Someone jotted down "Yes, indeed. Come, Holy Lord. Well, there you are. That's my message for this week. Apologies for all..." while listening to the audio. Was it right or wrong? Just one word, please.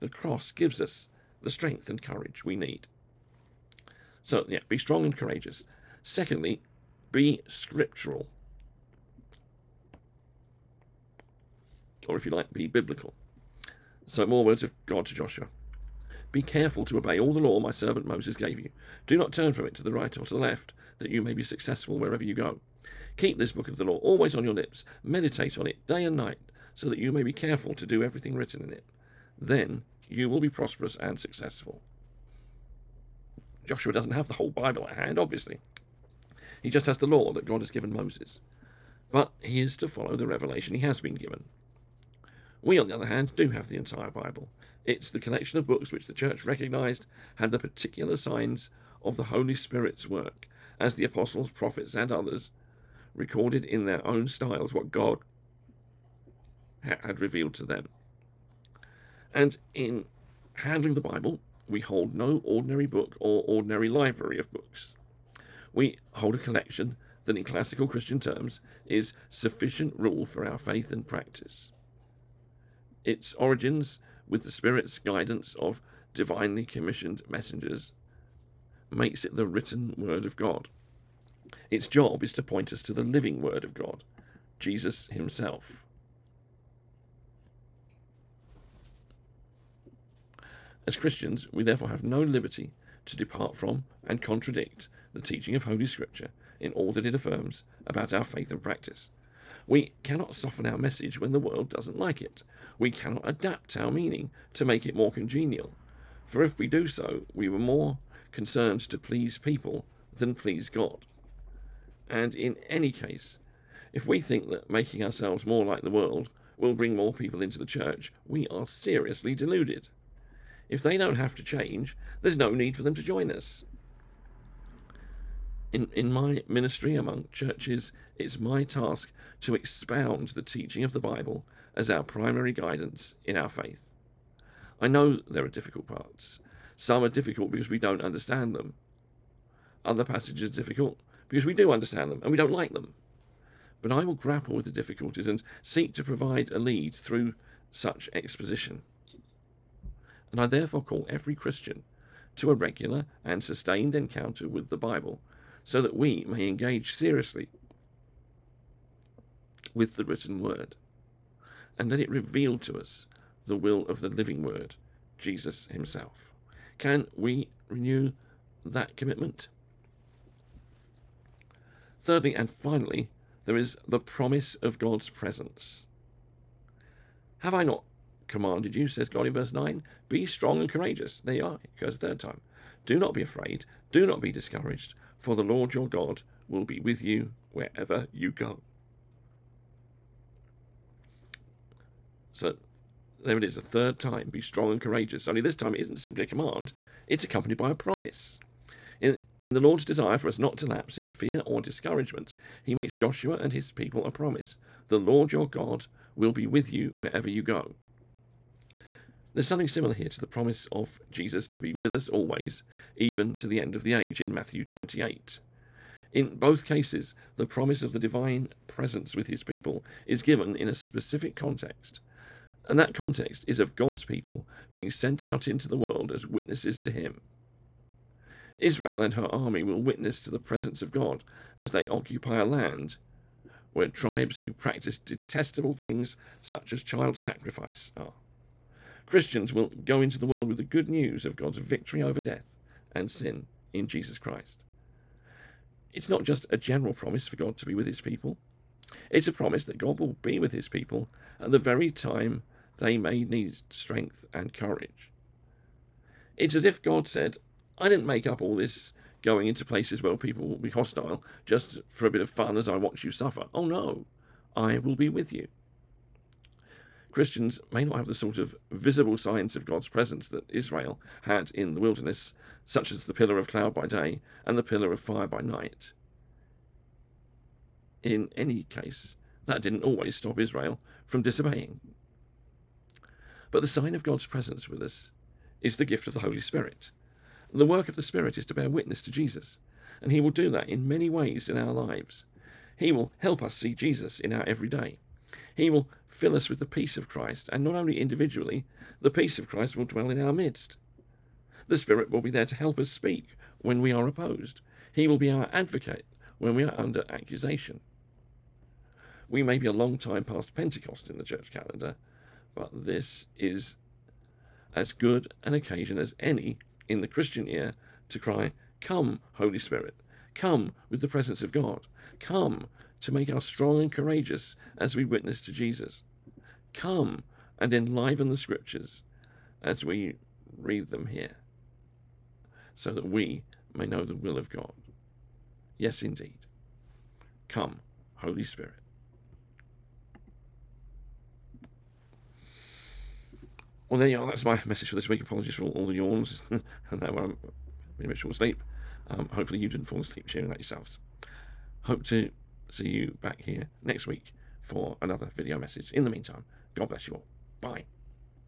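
wrong.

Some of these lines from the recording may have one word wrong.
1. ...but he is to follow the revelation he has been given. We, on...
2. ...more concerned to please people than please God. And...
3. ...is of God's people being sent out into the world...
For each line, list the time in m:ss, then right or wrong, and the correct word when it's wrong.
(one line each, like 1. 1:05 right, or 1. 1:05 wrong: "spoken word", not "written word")
1. 0:39 right
2. 1:47 right
3. 3:43 right.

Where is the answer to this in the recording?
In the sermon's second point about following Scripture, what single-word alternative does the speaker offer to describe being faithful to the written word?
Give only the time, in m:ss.
0:12.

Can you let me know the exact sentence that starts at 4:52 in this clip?
He will help us see Jesus in our everyday.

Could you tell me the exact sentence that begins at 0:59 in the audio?
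And in handling the Bible, we hold no ordinary book or ordinary library of books.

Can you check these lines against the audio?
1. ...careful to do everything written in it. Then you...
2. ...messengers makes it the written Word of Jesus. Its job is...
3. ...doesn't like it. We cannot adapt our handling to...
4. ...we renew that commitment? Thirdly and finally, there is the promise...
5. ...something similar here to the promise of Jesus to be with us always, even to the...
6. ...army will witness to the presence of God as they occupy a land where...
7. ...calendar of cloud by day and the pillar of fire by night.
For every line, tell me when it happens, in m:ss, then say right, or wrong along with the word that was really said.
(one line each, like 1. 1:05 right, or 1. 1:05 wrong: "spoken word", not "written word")
1. 0:27 right
2. 1:17 wrong: "God", not "Jesus"
3. 1:41 wrong: "meaning", not "handling"
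4. 2:47 right
5. 3:29 right
6. 3:49 right
7. 4:33 wrong: "pillar", not "calendar".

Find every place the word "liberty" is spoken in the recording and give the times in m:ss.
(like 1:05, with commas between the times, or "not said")
1:32.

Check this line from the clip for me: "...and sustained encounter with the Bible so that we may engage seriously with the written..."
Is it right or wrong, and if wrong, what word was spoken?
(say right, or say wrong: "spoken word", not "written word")
right.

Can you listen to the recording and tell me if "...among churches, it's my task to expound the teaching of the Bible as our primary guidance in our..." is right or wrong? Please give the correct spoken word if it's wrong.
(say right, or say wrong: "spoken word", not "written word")
right.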